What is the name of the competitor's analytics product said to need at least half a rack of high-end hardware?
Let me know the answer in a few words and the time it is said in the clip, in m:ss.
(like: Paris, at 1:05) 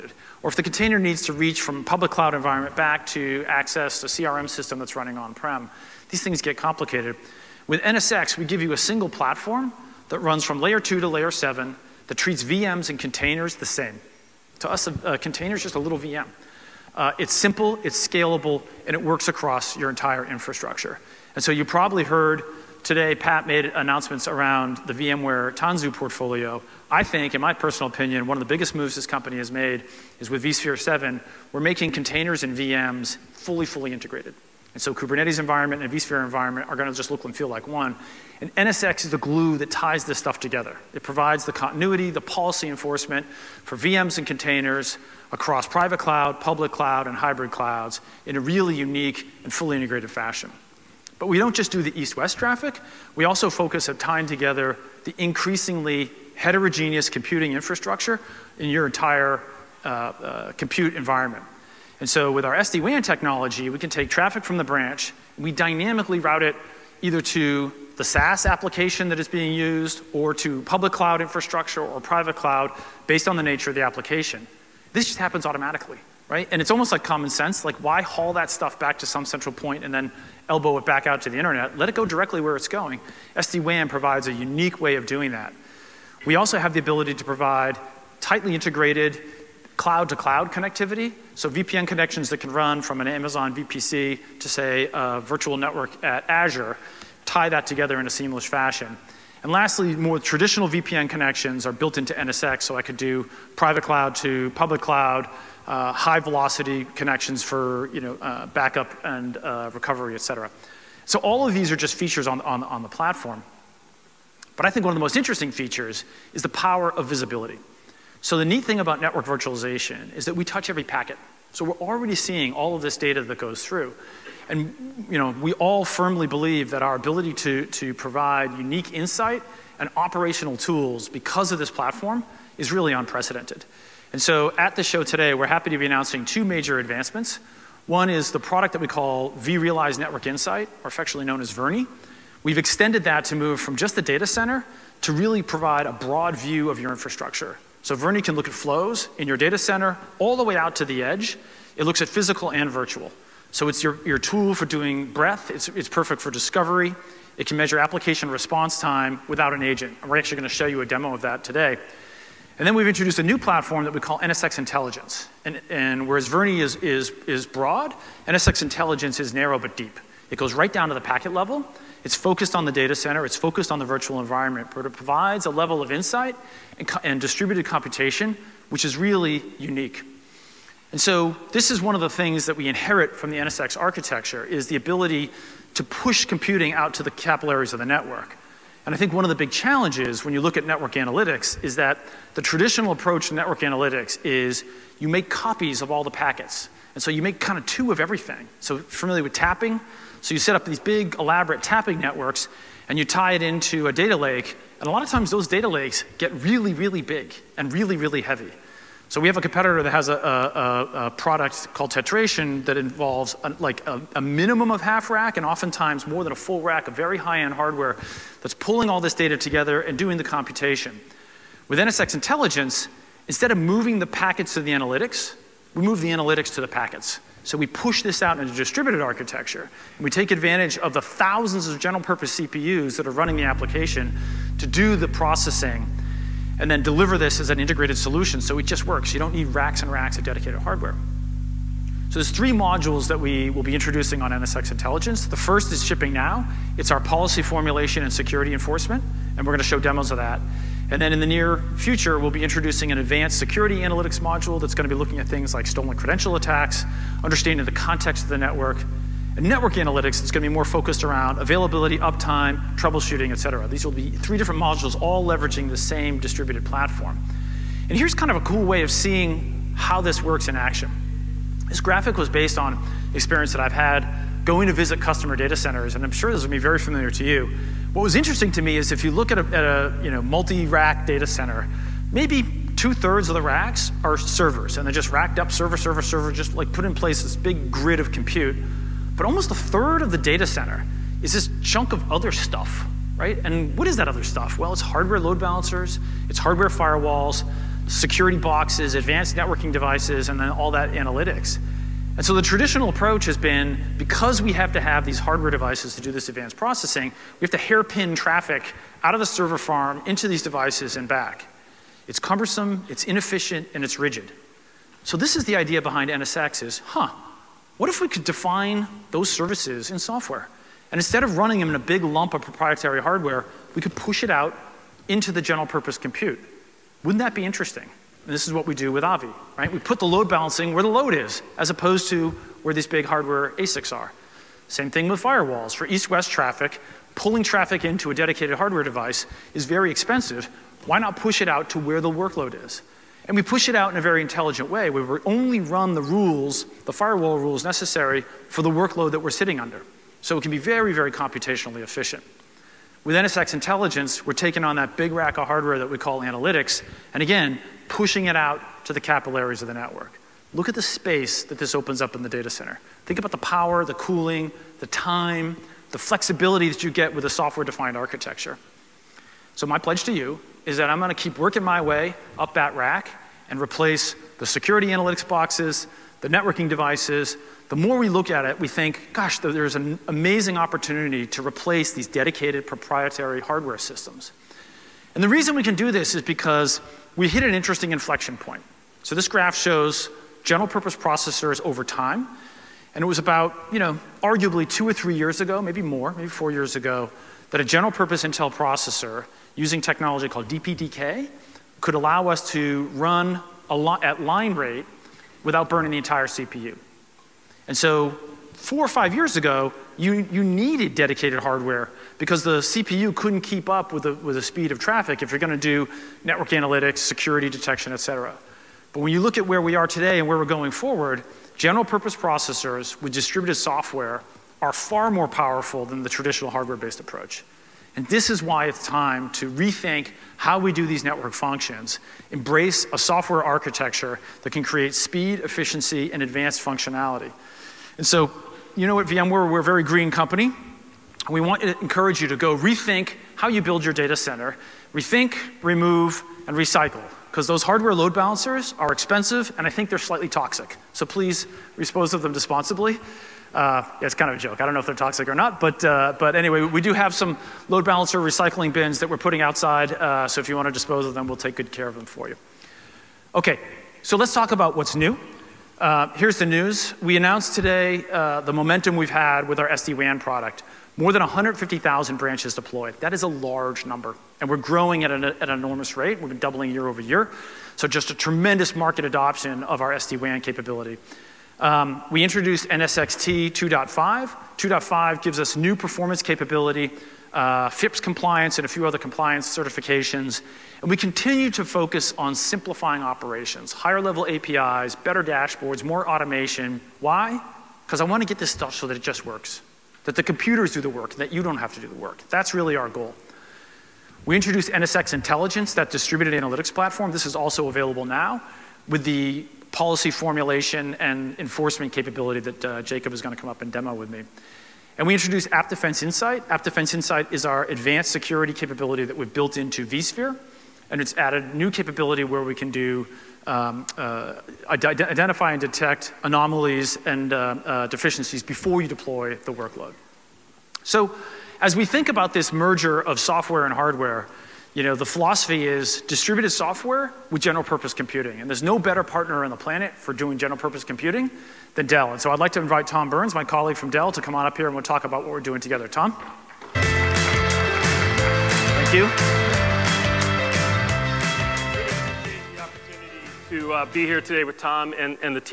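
Tetration, at 3:31.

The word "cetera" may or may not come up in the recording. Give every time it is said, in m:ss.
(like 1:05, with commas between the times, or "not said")
1:50, 4:23, 6:58.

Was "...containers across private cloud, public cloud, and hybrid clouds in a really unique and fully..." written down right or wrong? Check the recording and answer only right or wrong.
right.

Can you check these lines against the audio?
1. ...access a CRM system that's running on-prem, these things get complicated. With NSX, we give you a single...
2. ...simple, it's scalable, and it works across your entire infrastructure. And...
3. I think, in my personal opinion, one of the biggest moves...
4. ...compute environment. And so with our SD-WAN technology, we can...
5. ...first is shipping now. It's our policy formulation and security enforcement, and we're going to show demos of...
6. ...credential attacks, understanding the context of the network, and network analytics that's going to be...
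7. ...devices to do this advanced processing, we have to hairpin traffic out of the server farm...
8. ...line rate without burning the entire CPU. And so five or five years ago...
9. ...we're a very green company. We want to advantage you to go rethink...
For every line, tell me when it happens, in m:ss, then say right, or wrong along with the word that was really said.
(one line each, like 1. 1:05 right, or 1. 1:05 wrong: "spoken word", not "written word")
1. 0:03 right
2. 0:17 right
3. 0:26 right
4. 1:00 right
5. 4:05 right
6. 4:15 right
7. 5:05 right
8. 6:44 wrong: "four", not "five"
9. 7:19 wrong: "encourage", not "advantage".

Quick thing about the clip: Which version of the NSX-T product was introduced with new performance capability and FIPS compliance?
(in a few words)
2.5.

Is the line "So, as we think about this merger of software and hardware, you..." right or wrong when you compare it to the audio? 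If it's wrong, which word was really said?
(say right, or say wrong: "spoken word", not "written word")
right.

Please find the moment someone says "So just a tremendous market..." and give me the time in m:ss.
7:57.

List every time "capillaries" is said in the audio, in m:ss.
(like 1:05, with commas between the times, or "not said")
3:07, 5:58.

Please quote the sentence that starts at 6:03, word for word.
Think about the power, the cooling, the time, the flexibility that you get with a software-defined architecture.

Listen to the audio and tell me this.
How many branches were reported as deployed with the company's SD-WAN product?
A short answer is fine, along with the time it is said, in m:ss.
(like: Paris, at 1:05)
More than 150,000, at 7:50.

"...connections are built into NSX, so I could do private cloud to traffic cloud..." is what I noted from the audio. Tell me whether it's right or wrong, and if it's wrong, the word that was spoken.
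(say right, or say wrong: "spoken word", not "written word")
wrong: "public", not "traffic".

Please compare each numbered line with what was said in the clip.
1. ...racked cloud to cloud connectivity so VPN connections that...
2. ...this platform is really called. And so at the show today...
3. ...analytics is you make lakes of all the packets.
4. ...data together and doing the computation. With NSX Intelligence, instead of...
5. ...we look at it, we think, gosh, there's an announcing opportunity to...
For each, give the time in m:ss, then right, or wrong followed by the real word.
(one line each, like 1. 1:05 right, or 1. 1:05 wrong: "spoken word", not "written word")
1. 1:28 wrong: "integrated", not "racked"
2. 2:11 wrong: "unprecedented", not "called"
3. 3:13 wrong: "copies", not "lakes"
4. 3:39 right
5. 6:17 wrong: "amazing", not "announcing".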